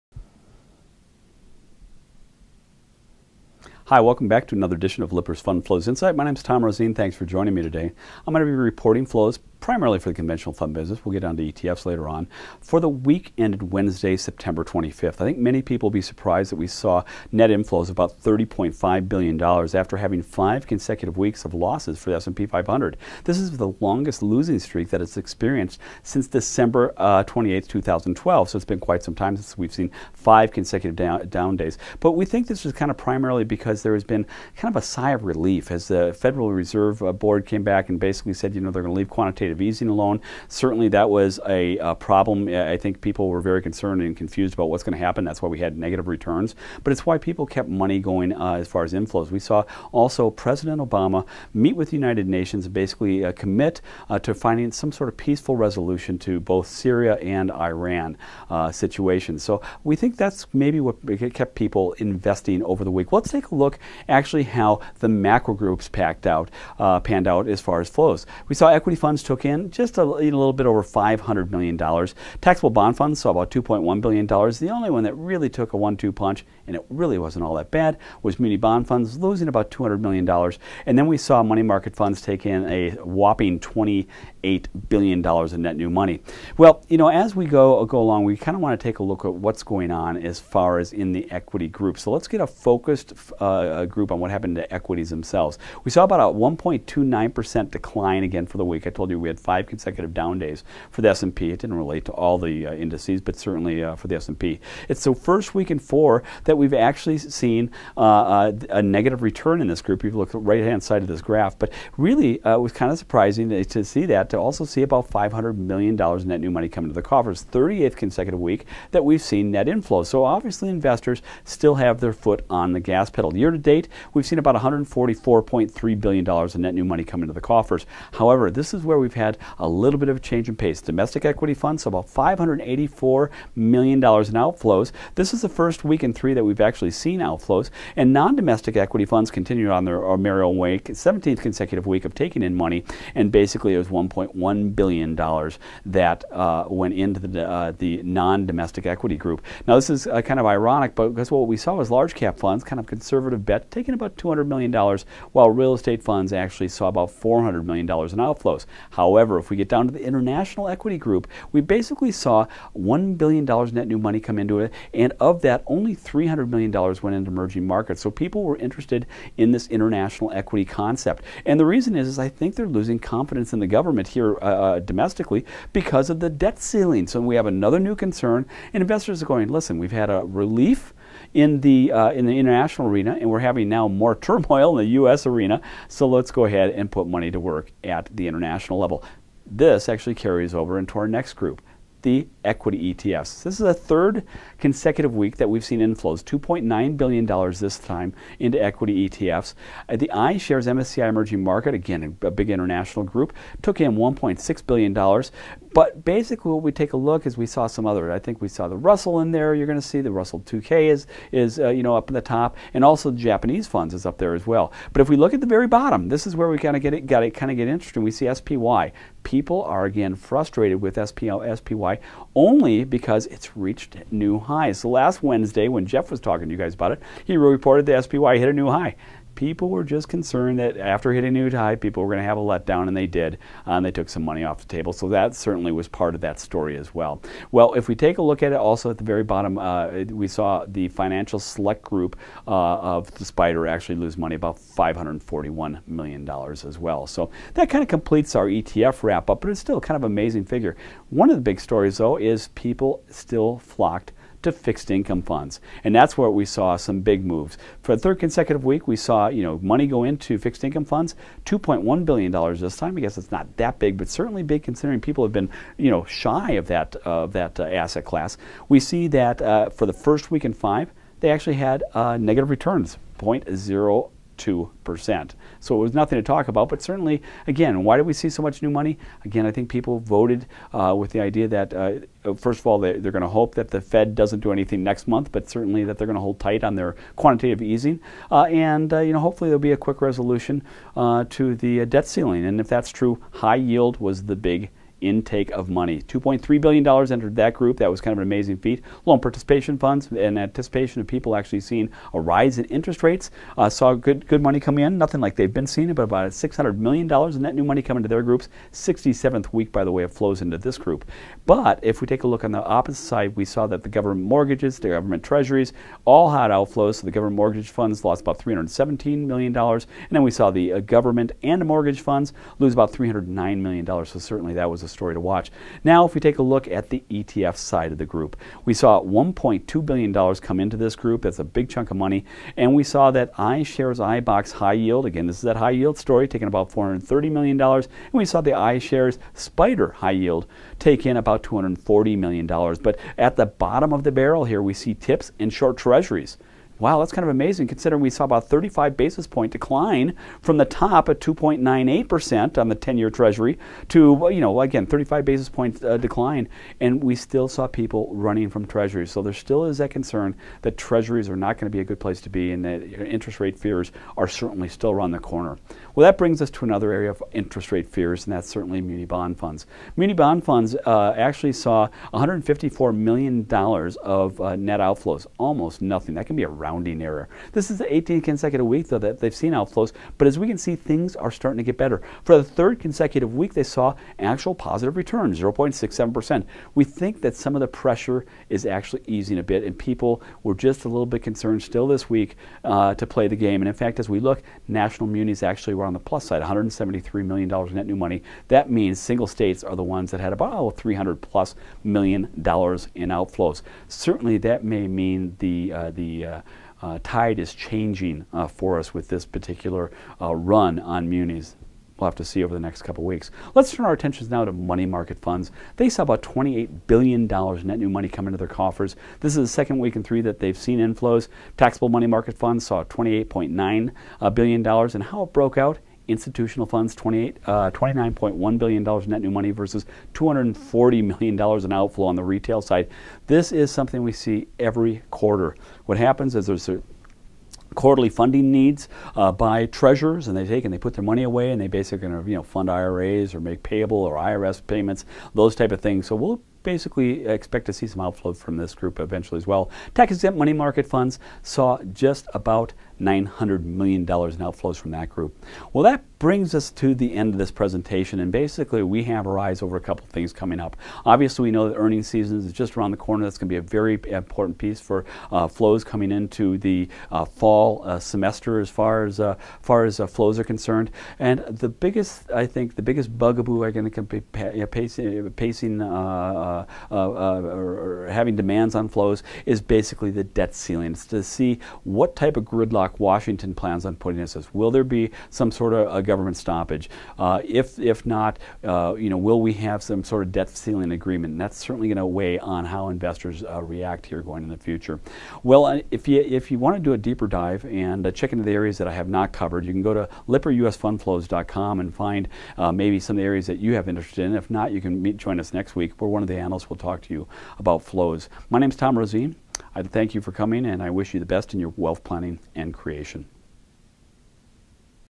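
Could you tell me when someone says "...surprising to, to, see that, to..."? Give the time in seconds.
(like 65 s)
112 s.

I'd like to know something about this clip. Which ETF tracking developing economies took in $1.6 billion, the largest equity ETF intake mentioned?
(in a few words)
iShares MSCI Emerging Market.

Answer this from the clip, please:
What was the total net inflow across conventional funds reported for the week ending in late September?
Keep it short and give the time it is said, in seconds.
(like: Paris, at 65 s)
$30.5 billion, at 18 s.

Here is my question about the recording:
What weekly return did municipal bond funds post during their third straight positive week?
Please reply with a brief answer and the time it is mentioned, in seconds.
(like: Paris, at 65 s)
0.67%, at 385 s.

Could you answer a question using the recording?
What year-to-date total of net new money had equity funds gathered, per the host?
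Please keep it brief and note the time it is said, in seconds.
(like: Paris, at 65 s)
$144.3 billion, at 124 s.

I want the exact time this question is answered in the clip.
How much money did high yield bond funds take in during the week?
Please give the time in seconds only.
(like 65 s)
296 s.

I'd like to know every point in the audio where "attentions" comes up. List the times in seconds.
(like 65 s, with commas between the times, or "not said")
413 s.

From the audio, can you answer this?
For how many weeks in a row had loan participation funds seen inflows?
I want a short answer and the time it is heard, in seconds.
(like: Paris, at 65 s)
67, at 308 s.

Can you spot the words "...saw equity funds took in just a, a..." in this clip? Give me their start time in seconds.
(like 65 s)
68 s.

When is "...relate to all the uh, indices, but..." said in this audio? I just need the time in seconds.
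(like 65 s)
101 s.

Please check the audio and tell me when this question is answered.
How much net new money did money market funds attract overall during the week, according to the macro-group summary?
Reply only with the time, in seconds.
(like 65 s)
83 s.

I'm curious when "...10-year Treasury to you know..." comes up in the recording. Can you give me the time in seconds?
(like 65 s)
352 s.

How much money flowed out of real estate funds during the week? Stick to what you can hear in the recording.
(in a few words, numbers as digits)
$400 million.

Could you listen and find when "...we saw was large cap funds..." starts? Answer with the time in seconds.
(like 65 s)
151 s.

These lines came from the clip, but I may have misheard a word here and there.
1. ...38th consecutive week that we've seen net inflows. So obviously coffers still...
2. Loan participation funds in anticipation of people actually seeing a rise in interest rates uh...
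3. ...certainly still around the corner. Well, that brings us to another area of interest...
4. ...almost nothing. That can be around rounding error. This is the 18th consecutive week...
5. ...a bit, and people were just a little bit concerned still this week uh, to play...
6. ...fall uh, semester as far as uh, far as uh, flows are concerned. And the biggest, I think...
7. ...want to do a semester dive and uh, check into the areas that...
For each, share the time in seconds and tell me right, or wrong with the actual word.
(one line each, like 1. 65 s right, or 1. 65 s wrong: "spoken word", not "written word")
1. 117 s wrong: "investors", not "coffers"
2. 299 s right
3. 364 s right
4. 375 s right
5. 389 s right
6. 467 s right
7. 496 s wrong: "deeper", not "semester".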